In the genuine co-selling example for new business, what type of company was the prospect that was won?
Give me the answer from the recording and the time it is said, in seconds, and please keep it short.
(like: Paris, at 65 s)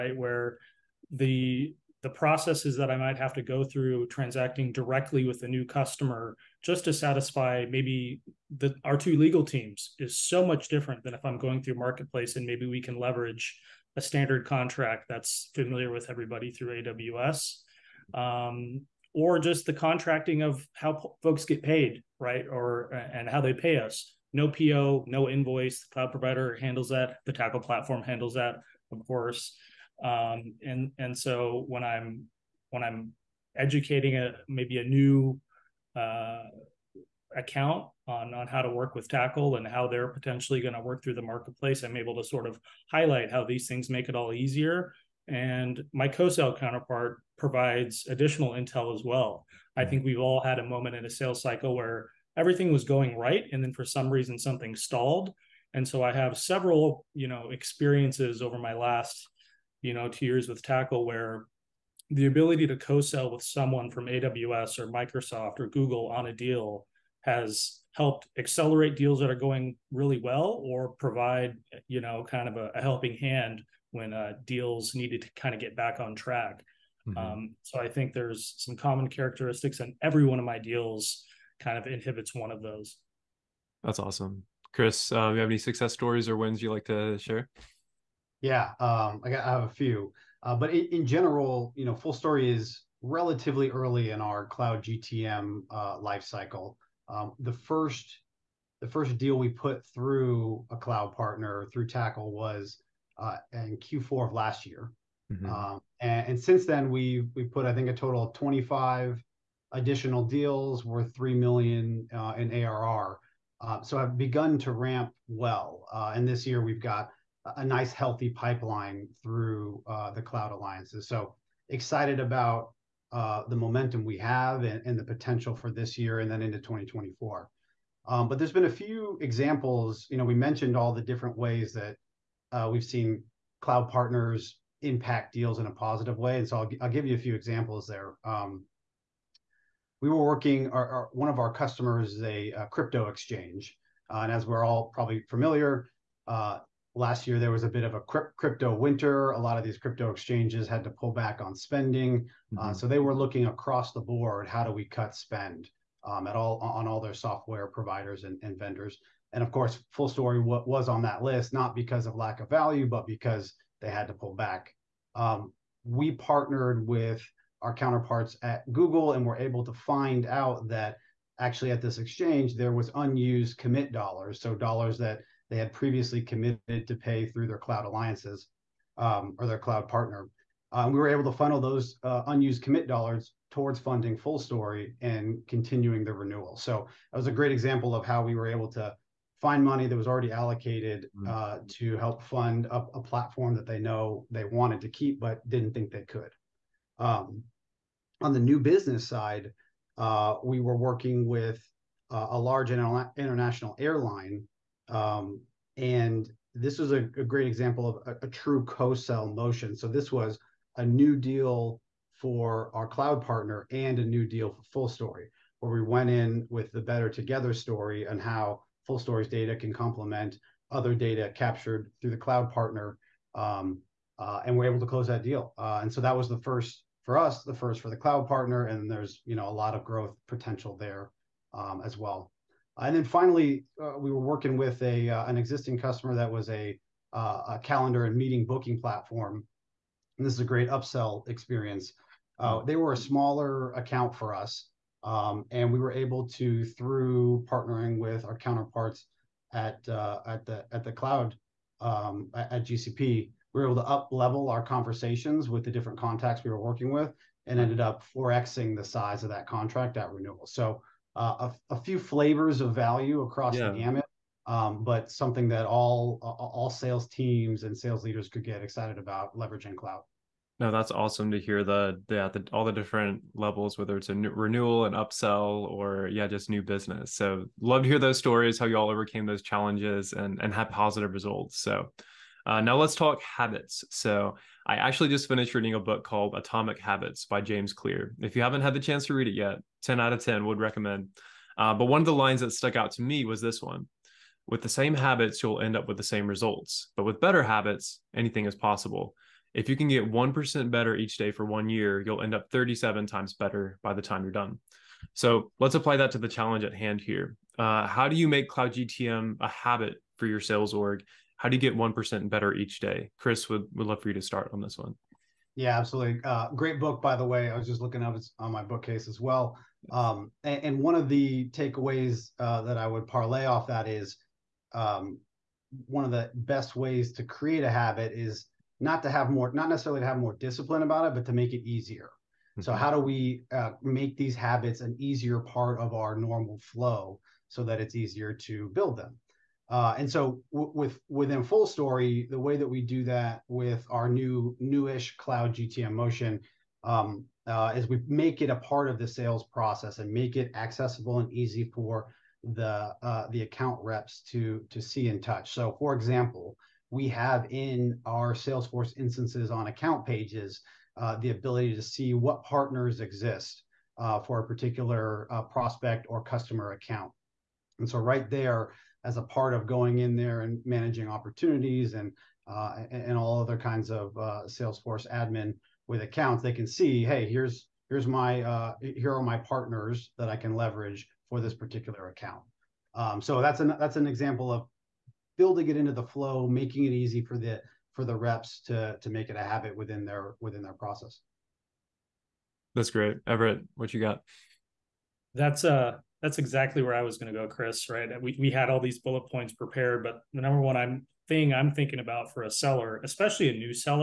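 international airline, at 203 s.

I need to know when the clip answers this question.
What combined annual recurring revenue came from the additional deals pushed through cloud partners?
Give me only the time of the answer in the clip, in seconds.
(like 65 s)
111 s.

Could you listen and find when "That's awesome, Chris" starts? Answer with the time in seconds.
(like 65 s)
83 s.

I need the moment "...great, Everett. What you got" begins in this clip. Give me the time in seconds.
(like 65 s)
392 s.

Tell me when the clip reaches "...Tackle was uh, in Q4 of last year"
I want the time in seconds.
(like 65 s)
101 s.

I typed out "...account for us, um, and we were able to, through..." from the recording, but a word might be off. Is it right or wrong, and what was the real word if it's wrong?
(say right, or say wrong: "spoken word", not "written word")
right.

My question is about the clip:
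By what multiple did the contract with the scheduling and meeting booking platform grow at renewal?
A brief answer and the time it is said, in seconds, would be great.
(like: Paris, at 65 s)
4x, at 258 s.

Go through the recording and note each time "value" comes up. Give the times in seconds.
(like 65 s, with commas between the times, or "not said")
162 s, 262 s.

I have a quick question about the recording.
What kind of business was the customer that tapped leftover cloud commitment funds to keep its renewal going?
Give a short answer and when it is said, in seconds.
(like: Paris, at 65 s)
crypto exchange, at 142 s.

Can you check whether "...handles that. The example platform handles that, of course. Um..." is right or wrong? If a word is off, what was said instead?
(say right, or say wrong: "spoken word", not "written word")
wrong: "tackle", not "example".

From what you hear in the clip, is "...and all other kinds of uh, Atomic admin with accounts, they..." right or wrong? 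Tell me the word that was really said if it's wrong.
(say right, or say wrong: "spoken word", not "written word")
wrong: "Salesforce", not "Atomic".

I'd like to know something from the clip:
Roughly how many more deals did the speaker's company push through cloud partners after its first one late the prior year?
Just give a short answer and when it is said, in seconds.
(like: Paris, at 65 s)
25, at 108 s.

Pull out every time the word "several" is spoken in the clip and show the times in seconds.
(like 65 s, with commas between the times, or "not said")
56 s.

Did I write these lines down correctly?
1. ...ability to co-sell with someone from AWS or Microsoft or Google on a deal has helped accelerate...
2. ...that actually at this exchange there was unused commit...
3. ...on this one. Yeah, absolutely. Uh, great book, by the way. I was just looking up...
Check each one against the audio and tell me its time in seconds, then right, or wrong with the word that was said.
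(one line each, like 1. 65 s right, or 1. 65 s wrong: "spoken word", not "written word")
1. 62 s right
2. 170 s right
3. 314 s right.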